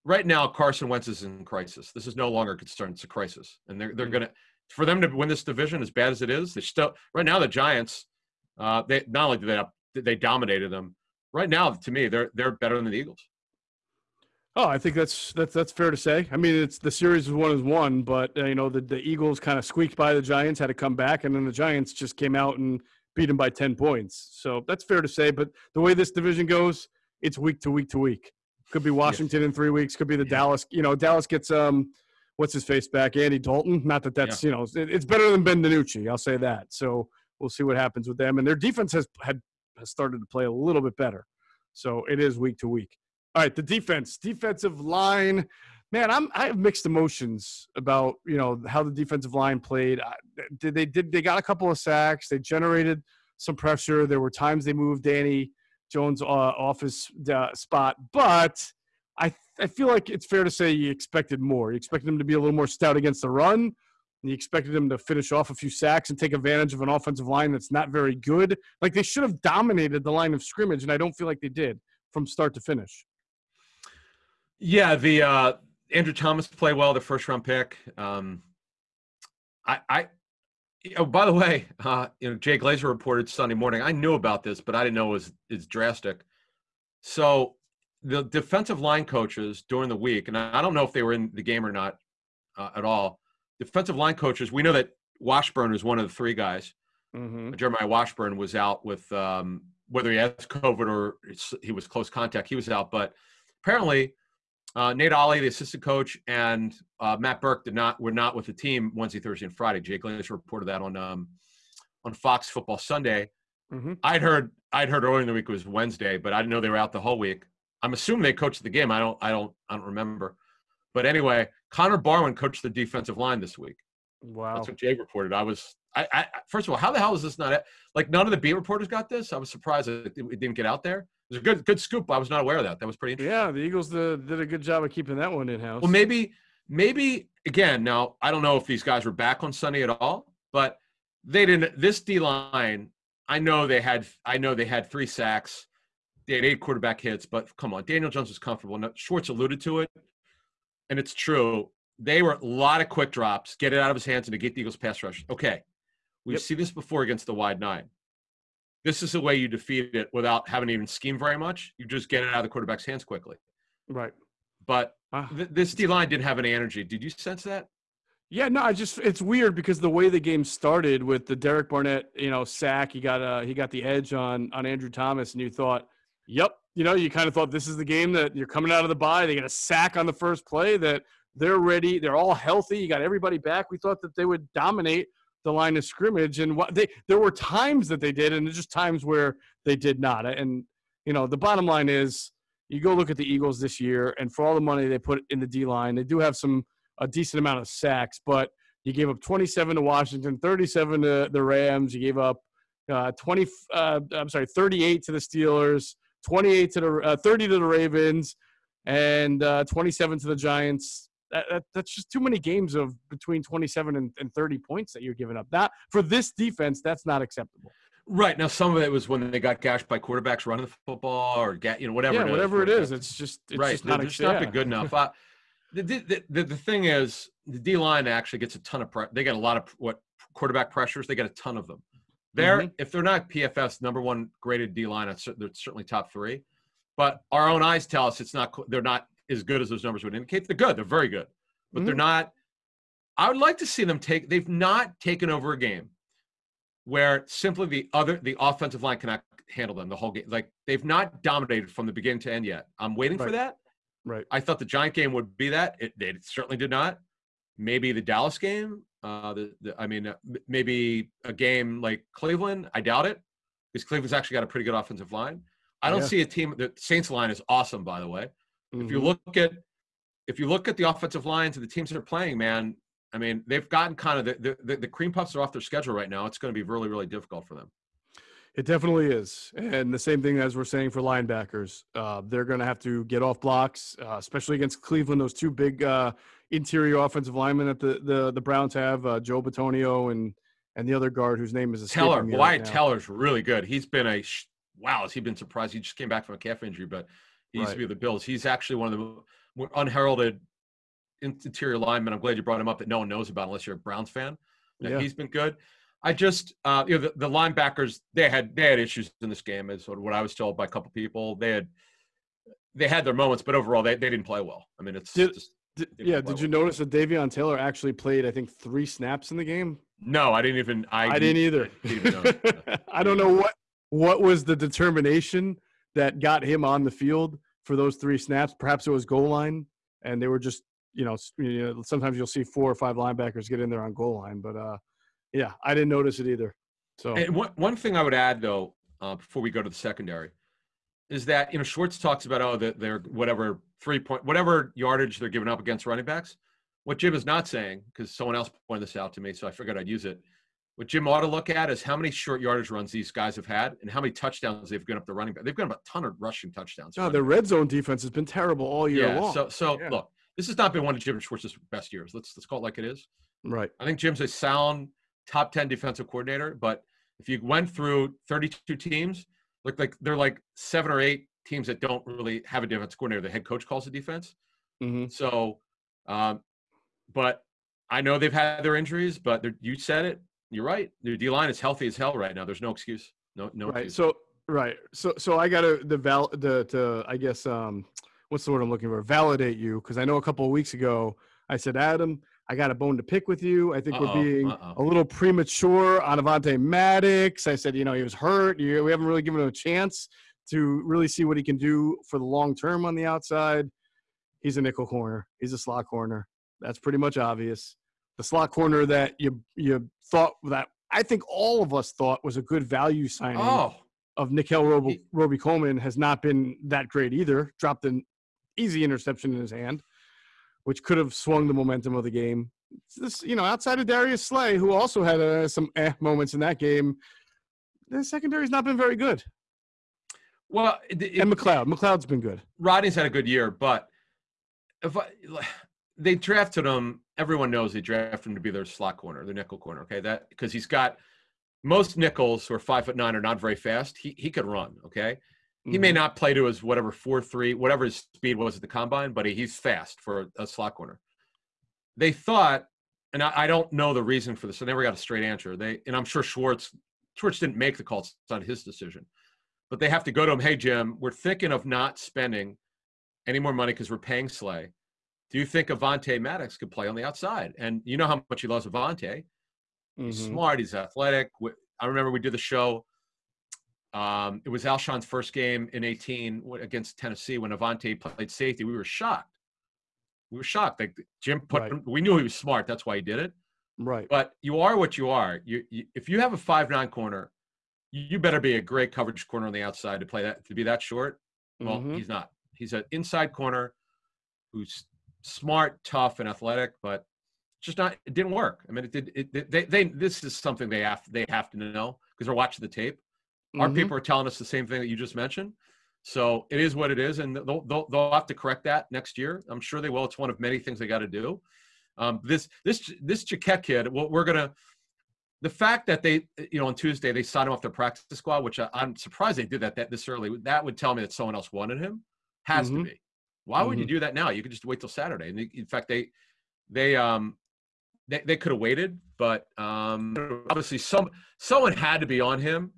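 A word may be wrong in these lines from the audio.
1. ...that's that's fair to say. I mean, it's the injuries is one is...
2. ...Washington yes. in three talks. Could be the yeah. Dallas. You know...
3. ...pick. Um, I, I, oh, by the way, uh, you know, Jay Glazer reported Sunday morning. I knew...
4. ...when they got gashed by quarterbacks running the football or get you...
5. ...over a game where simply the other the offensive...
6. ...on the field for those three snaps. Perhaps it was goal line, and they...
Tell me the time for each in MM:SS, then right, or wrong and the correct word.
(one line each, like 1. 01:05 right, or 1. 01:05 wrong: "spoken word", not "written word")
1. 00:15 wrong: "series", not "injuries"
2. 00:28 wrong: "weeks", not "talks"
3. 01:17 right
4. 03:39 right
5. 04:05 right
6. 05:26 right.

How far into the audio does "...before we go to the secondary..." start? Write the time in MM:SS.
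05:39.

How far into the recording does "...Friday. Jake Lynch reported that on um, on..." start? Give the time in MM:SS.
01:49.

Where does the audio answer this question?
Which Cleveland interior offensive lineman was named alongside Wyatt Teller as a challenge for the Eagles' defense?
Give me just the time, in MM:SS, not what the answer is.
04:49.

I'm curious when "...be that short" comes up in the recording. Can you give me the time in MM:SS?
08:10.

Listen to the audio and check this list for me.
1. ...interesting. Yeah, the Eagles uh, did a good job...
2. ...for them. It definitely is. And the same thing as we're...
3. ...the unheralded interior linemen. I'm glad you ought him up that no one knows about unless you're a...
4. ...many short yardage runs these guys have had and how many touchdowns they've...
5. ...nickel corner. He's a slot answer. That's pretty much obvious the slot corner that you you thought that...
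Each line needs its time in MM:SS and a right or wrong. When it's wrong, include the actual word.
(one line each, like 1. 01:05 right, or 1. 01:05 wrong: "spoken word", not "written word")
1. 02:13 right
2. 04:37 right
3. 04:58 wrong: "brought", not "ought"
4. 05:51 right
5. 06:44 wrong: "corner", not "answer".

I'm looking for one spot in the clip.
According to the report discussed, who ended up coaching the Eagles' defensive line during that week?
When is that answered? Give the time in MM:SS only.
02:01.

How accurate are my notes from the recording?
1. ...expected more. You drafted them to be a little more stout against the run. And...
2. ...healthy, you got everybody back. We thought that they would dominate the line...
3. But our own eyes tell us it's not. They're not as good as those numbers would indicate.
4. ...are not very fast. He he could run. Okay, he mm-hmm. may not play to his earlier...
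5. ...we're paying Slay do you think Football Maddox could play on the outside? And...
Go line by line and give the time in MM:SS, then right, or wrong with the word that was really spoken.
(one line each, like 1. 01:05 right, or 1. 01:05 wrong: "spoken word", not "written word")
1. 01:00 wrong: "expected", not "drafted"
2. 03:02 right
3. 03:56 right
4. 07:23 wrong: "whatever", not "earlier"
5. 07:43 wrong: "Avonte", not "Football".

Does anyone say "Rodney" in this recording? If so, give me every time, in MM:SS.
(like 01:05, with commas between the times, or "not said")
07:12.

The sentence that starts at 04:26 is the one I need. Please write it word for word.
The Saints line is awesome, by the way.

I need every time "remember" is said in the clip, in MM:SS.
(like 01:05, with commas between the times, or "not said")
01:59, 07:51.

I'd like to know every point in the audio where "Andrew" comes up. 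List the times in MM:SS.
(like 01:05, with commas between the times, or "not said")
01:15, 02:54.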